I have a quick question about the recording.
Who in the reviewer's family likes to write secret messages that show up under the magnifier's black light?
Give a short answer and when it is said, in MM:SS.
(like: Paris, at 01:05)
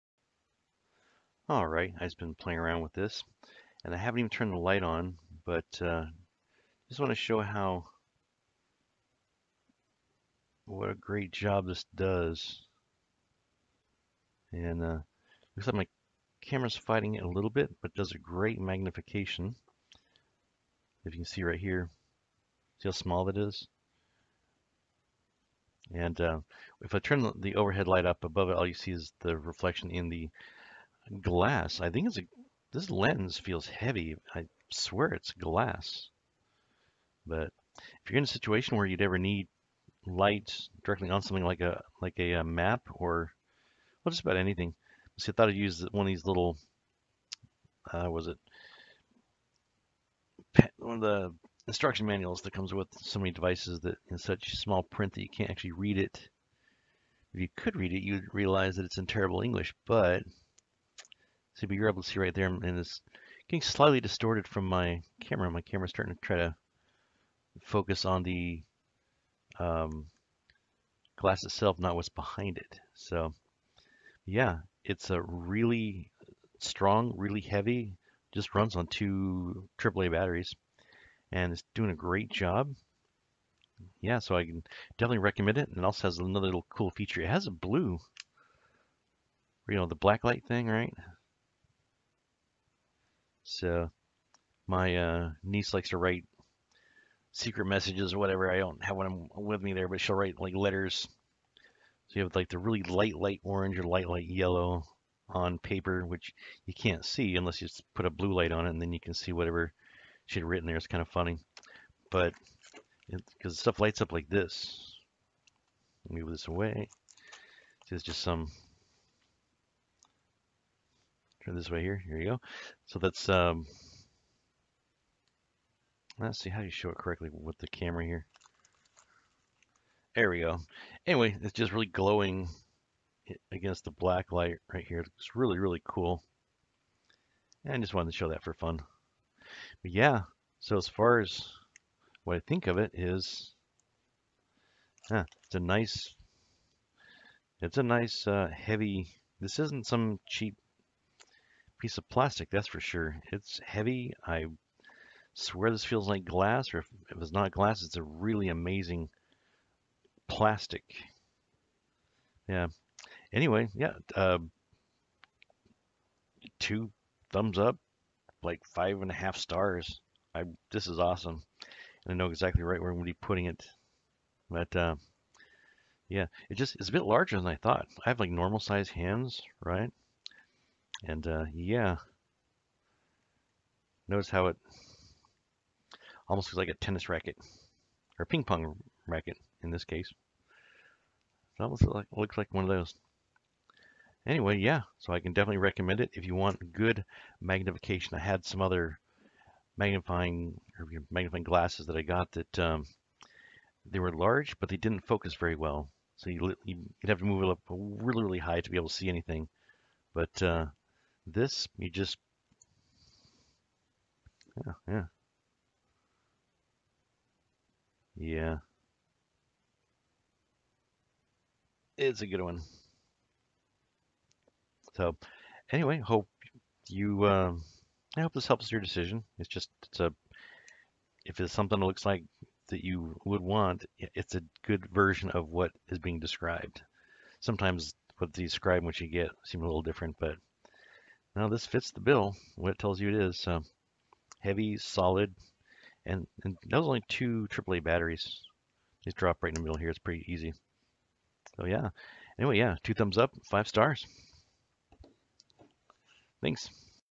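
niece, at 01:35.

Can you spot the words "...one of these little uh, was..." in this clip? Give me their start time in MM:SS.
00:45.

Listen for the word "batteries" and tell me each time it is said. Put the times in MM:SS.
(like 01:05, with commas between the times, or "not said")
01:20, 04:07.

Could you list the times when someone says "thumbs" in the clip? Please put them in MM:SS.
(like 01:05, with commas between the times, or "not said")
02:47, 04:12.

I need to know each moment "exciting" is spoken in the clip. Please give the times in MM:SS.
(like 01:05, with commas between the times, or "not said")
not said.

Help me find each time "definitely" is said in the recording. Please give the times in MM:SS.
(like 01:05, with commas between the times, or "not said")
01:24, 03:15.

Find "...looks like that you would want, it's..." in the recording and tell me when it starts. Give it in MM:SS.
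03:51.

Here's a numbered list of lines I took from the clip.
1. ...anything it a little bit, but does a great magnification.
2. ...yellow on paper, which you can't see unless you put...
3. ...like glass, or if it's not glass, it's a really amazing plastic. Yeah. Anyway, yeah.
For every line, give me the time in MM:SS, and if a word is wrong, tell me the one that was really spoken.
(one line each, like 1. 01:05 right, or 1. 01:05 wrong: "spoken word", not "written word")
1. 00:16 wrong: "fighting", not "anything"
2. 01:44 right
3. 02:36 right.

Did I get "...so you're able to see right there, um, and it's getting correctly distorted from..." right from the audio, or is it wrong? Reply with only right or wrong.
wrong.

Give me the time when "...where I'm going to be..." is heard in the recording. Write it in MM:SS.
02:52.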